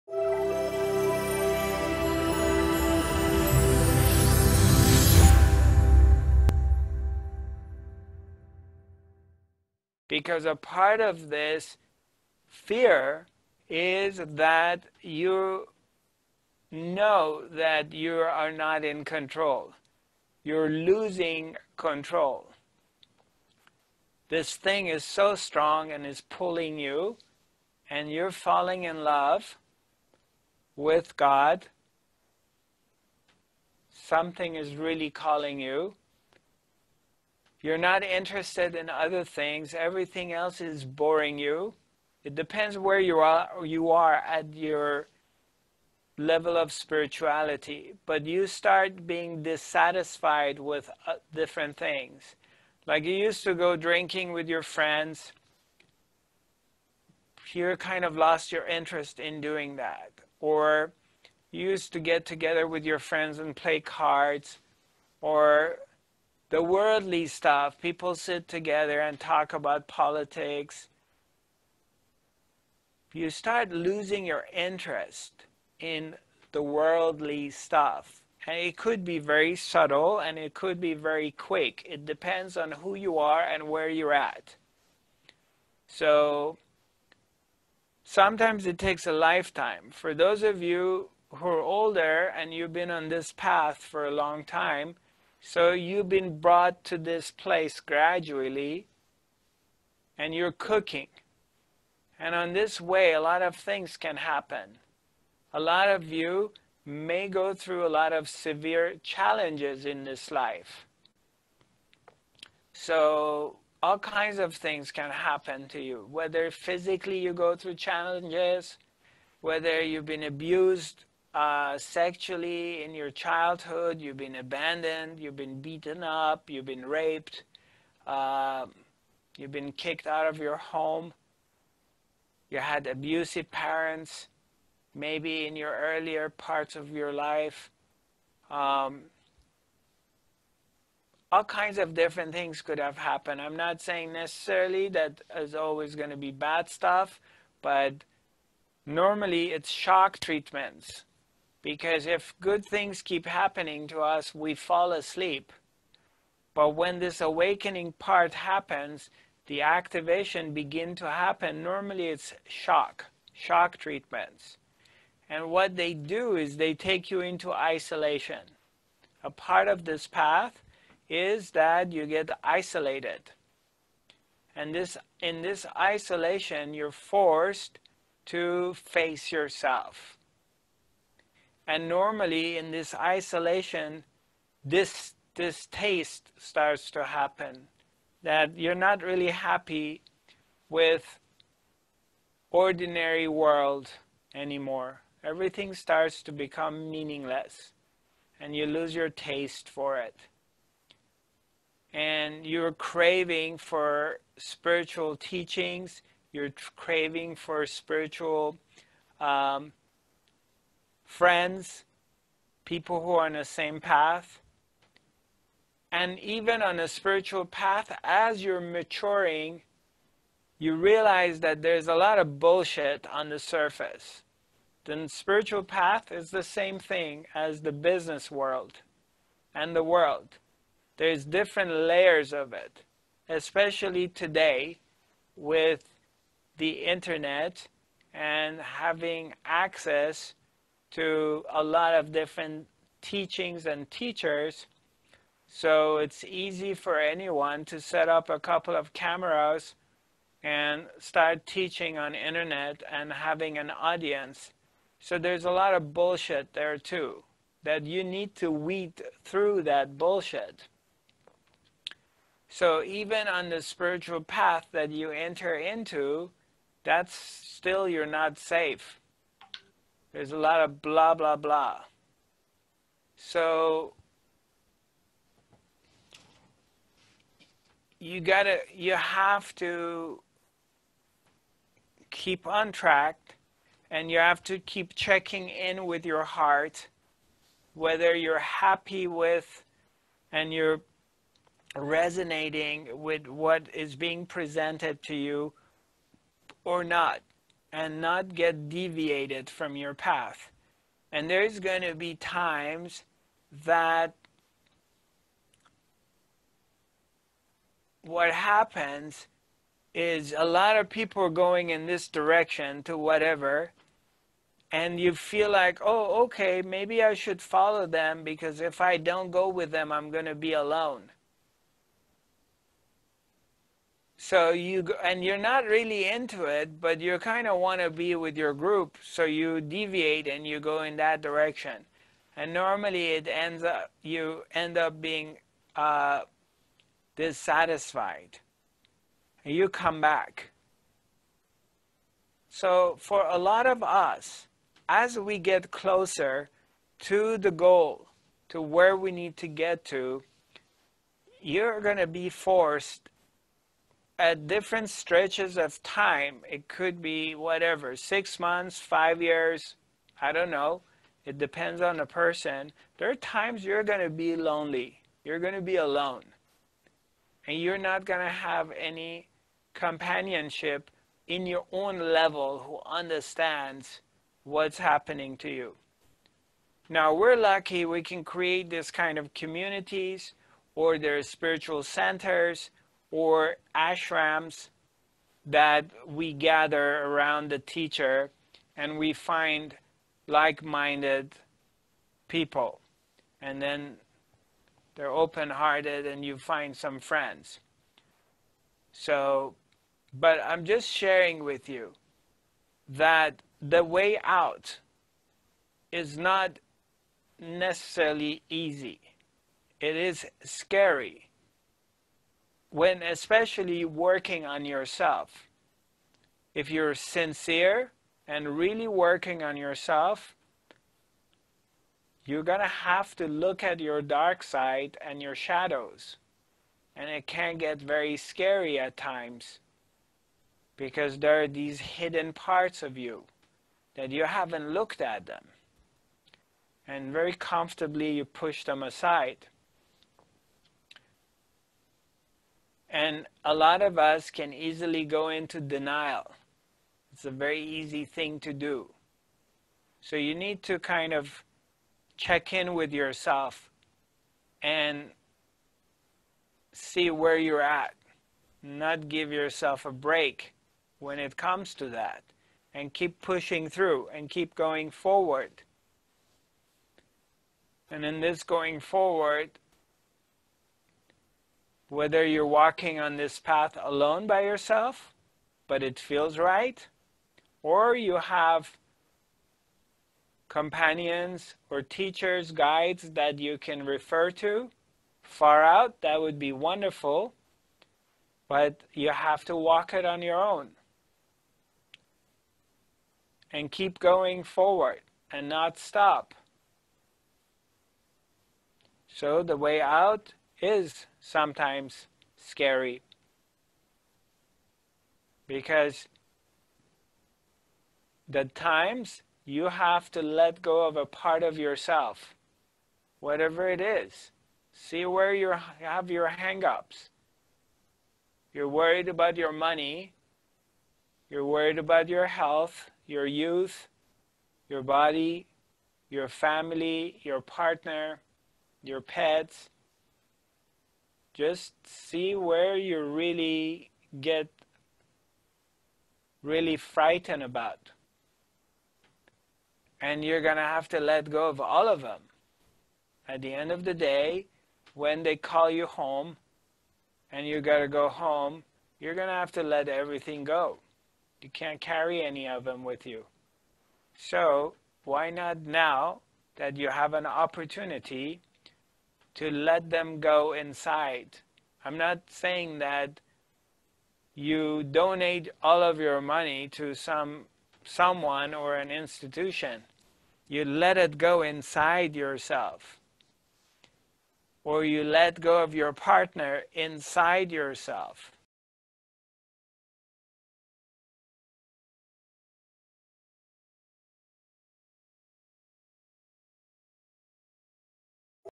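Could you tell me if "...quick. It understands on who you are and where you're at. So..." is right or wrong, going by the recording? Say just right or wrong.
wrong.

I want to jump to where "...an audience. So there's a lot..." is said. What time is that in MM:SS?
04:13.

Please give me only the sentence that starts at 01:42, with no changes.
And on this way, a lot of things can happen.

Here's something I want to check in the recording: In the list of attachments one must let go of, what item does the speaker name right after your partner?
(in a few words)
pets.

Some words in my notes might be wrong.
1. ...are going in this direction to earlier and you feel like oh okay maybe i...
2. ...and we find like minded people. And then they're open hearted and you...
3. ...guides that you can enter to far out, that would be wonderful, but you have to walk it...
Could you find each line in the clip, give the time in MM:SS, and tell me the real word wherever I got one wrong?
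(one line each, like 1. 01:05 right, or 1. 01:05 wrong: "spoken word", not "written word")
1. 05:11 wrong: "whatever", not "earlier"
2. 06:28 right
3. 08:02 wrong: "refer", not "enter".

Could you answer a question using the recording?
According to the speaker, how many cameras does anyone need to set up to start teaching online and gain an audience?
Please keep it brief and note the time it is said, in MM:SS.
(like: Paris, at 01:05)
a couple, at 04:08.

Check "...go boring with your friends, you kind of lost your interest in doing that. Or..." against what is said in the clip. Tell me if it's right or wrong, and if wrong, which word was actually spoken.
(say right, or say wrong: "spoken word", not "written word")
wrong: "drinking", not "boring".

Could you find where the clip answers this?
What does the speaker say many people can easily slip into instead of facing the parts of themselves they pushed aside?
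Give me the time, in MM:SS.
07:25.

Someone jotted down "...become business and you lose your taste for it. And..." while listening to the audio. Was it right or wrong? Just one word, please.
wrong.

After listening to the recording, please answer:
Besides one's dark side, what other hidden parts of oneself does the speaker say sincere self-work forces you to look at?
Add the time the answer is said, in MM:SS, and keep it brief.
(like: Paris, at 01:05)
shadows, at 07:05.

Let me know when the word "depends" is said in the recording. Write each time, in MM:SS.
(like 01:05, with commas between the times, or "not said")
00:42, 01:22, 06:01.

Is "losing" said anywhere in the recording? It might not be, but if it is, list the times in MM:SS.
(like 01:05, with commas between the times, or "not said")
00:20, 01:13.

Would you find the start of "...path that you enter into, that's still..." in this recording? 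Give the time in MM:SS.
04:24.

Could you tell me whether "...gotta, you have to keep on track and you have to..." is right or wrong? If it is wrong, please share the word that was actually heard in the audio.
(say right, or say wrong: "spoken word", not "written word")
right.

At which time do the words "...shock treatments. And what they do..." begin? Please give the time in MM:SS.
02:43.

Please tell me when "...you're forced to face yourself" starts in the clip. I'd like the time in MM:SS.
02:56.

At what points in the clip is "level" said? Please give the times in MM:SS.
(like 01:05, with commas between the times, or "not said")
00:46, 06:11.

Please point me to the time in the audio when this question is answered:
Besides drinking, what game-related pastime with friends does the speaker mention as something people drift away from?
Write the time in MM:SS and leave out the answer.
01:03.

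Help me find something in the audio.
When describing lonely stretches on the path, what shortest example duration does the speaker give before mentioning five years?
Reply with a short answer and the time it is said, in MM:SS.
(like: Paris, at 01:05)
6 months, at 05:57.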